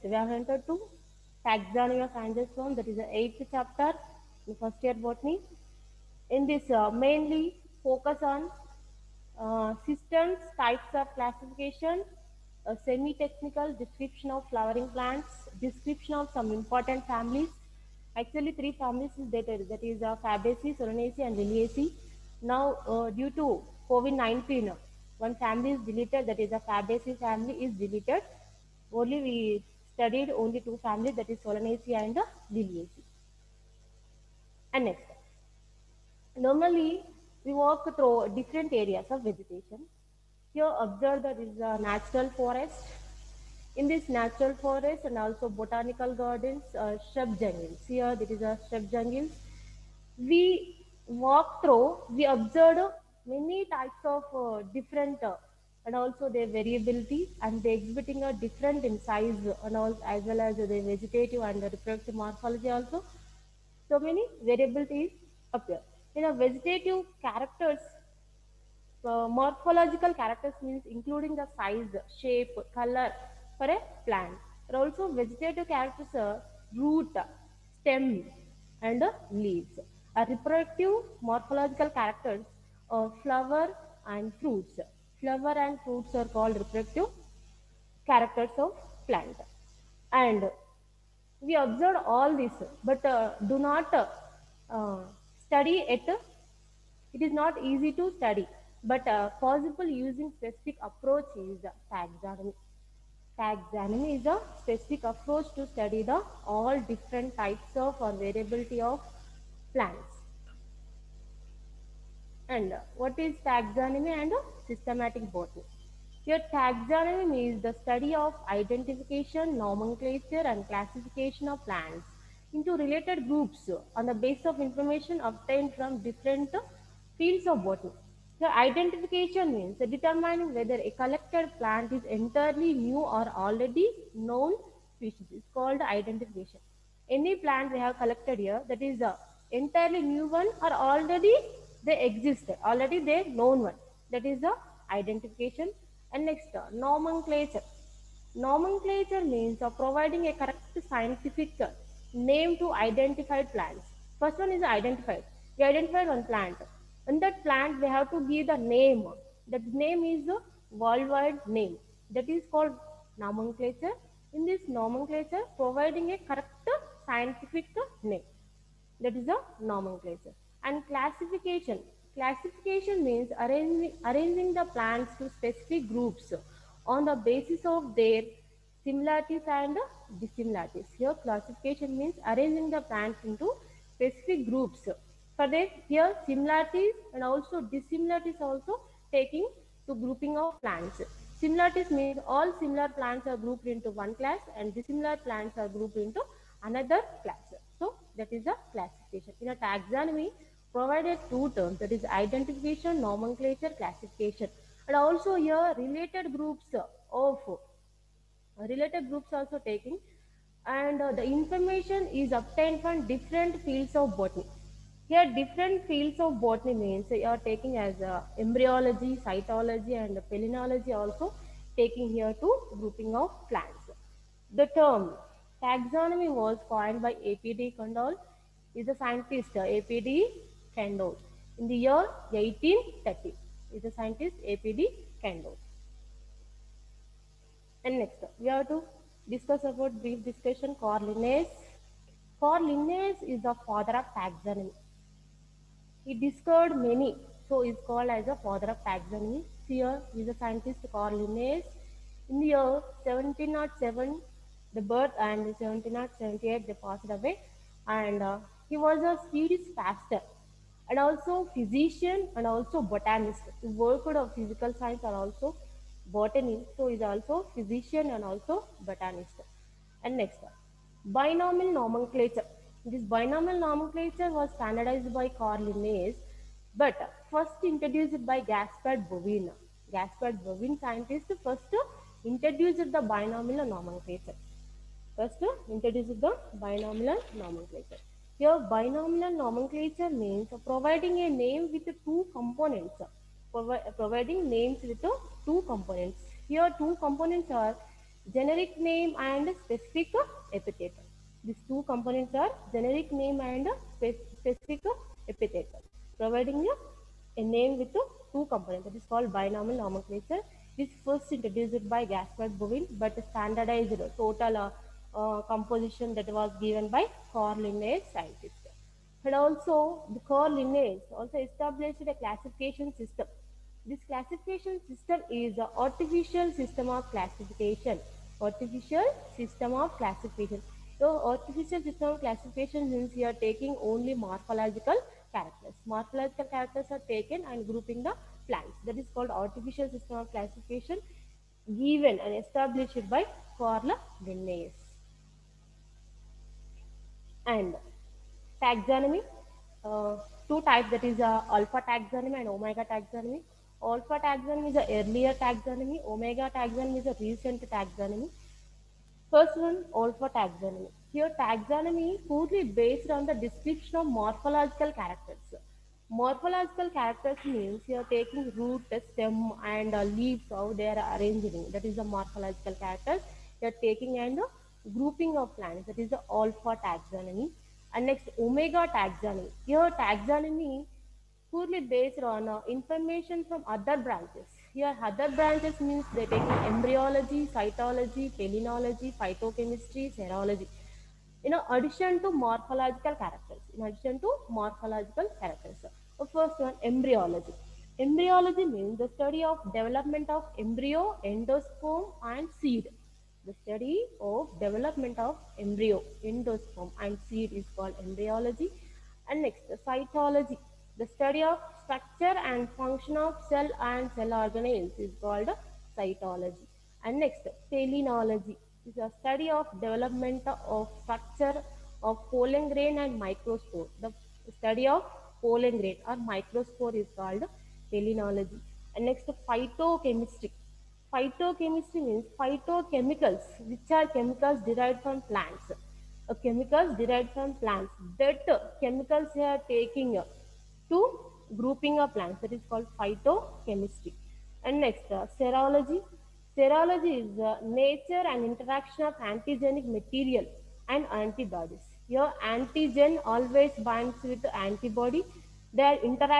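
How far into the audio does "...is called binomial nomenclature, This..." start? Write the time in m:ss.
5:08.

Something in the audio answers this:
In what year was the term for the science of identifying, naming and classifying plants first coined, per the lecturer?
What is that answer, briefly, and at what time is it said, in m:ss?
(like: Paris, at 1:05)
1830, at 3:52.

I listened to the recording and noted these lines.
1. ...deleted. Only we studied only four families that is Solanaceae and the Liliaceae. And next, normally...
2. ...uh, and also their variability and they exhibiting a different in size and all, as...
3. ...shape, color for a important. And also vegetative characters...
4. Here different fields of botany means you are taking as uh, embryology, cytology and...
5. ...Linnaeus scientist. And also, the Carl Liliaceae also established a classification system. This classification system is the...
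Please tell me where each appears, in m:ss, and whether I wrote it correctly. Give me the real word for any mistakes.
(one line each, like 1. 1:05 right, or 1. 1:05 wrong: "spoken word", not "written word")
1. 0:27 wrong: "two", not "four"
2. 0:55 right
3. 1:12 wrong: "plant", not "important"
4. 3:35 right
5. 5:17 wrong: "Linnaeus", not "Liliaceae".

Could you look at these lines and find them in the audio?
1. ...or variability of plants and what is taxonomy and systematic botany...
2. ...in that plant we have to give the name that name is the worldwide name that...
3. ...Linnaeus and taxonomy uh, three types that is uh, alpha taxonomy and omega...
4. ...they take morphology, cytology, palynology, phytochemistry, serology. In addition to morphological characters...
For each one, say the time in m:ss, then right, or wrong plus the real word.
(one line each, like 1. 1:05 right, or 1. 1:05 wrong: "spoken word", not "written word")
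1. 1:47 right
2. 2:37 right
3. 5:44 wrong: "two", not "three"
4. 6:26 wrong: "embryology", not "morphology".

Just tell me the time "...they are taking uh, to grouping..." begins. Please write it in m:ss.
7:19.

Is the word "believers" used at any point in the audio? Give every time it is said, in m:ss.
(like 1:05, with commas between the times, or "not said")
not said.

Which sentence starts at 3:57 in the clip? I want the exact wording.
And next, we have to discuss about brief discussion Carl Linnaeus.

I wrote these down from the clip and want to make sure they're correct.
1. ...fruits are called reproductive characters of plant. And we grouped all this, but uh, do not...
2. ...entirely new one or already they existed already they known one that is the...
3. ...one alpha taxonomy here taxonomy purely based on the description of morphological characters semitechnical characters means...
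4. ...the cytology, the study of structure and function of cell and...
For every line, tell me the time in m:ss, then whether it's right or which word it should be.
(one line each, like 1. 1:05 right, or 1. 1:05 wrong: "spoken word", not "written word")
1. 1:25 wrong: "observed", not "grouped"
2. 2:19 right
3. 5:59 wrong: "morphological", not "semitechnical"
4. 6:49 right.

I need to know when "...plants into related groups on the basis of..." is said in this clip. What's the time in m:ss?
2:01.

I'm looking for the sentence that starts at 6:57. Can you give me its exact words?
And next, palynology is a study of development of structure of pollen grain and microspore.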